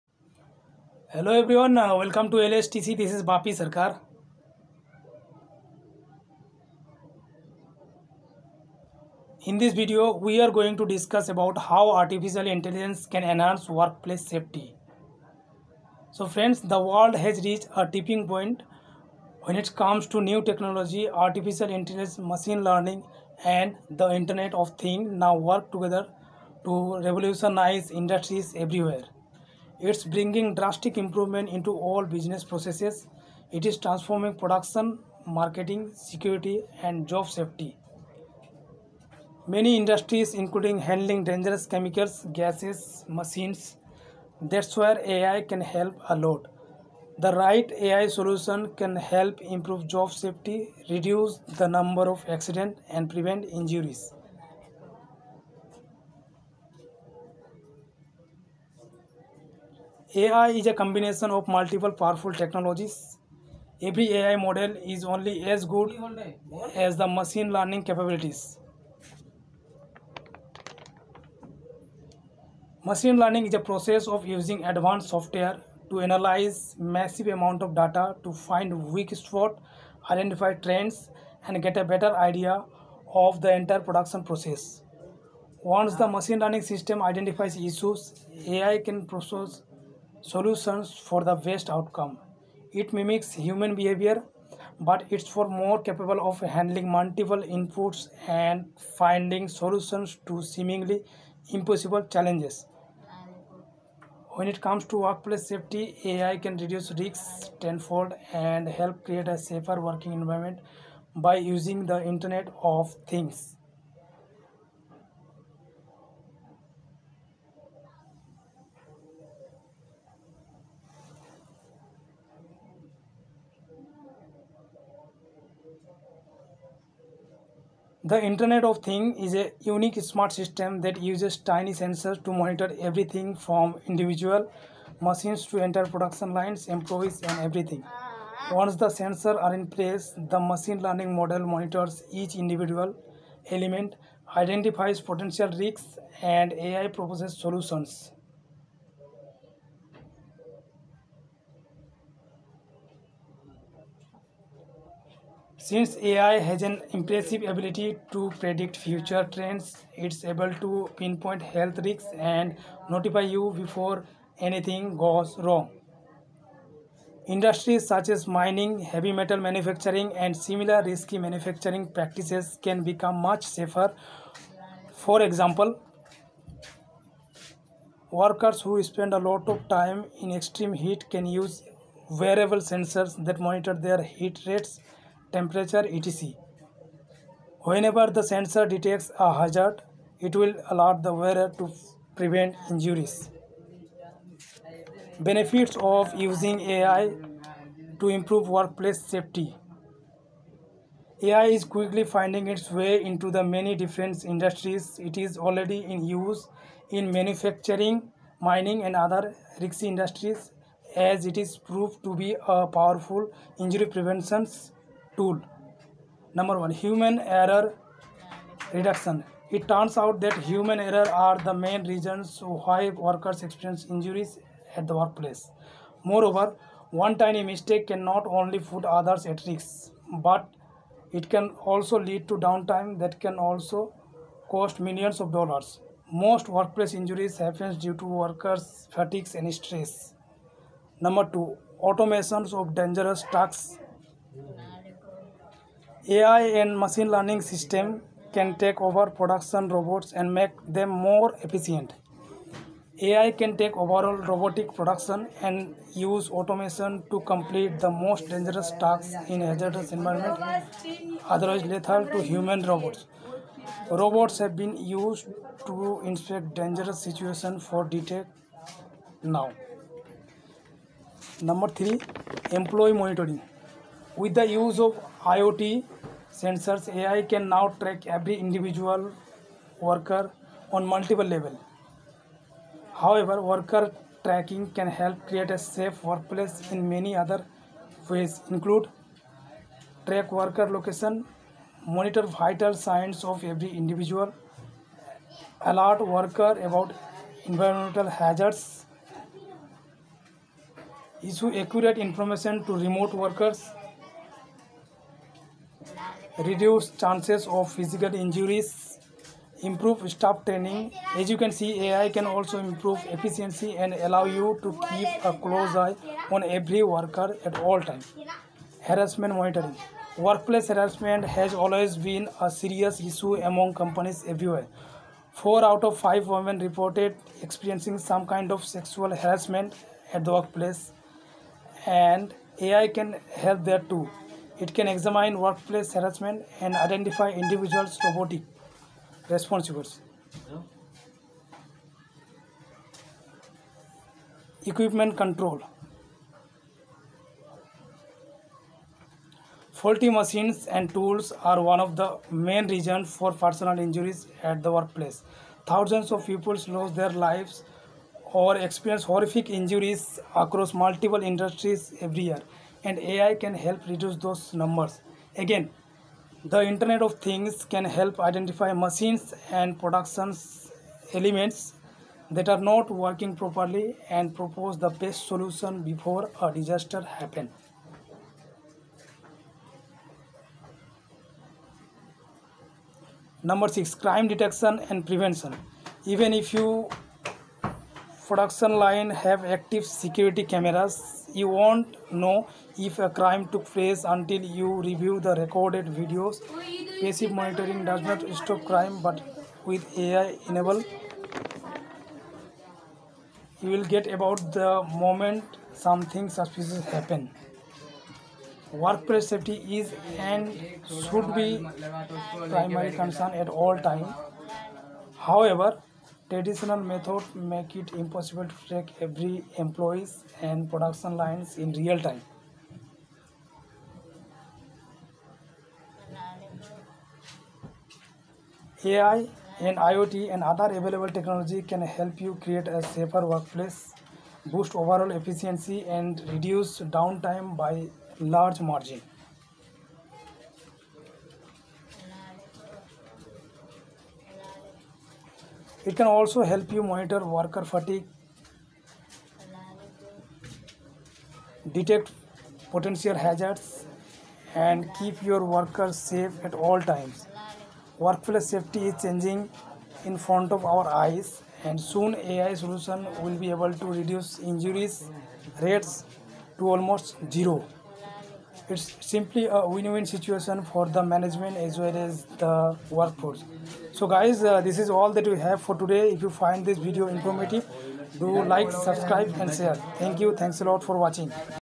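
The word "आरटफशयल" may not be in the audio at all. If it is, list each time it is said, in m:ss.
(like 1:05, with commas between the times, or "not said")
0:11, 0:21.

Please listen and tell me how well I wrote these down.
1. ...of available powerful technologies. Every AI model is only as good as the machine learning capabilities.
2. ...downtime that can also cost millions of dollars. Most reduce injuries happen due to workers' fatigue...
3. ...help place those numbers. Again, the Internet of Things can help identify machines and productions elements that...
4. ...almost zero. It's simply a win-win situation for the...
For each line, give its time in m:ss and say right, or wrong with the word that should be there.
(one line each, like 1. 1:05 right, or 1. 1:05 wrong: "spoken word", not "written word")
1. 1:01 wrong: "multiple", not "available"
2. 3:52 wrong: "workplace", not "reduce"
3. 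6:03 wrong: "reduce", not "place"
4. 7:46 right.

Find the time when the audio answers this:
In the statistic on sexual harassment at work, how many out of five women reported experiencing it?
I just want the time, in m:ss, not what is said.
5:25.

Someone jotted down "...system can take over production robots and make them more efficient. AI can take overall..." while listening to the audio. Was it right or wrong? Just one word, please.
right.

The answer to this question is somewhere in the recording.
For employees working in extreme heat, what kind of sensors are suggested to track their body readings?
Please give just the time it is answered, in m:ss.
3:02.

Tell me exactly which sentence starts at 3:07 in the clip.
Whenever the sensor detects a hazard, it will alert the wearer to prevent injuries.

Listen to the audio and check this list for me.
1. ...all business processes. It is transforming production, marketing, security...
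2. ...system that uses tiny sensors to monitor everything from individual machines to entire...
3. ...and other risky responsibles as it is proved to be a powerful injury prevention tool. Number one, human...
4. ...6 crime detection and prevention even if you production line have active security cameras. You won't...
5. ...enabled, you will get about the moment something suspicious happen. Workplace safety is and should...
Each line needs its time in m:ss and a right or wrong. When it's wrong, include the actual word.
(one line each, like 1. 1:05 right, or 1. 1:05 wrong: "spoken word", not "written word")
1. 0:31 right
2. 2:10 right
3. 3:28 wrong: "industries", not "responsibles"
4. 6:23 right
5. 6:40 right.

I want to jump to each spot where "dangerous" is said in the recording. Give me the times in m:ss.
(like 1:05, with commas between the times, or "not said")
0:41, 4:02, 4:18, 4:26.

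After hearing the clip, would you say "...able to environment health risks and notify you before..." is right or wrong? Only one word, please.
wrong.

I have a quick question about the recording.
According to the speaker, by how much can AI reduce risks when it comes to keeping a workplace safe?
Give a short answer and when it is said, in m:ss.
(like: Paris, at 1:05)
tenfold, at 1:47.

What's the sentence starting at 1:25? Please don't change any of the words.
Once the machine learning system identifies issues, AI can process solutions for the best outcome.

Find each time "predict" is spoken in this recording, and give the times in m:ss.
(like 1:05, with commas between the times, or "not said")
2:38.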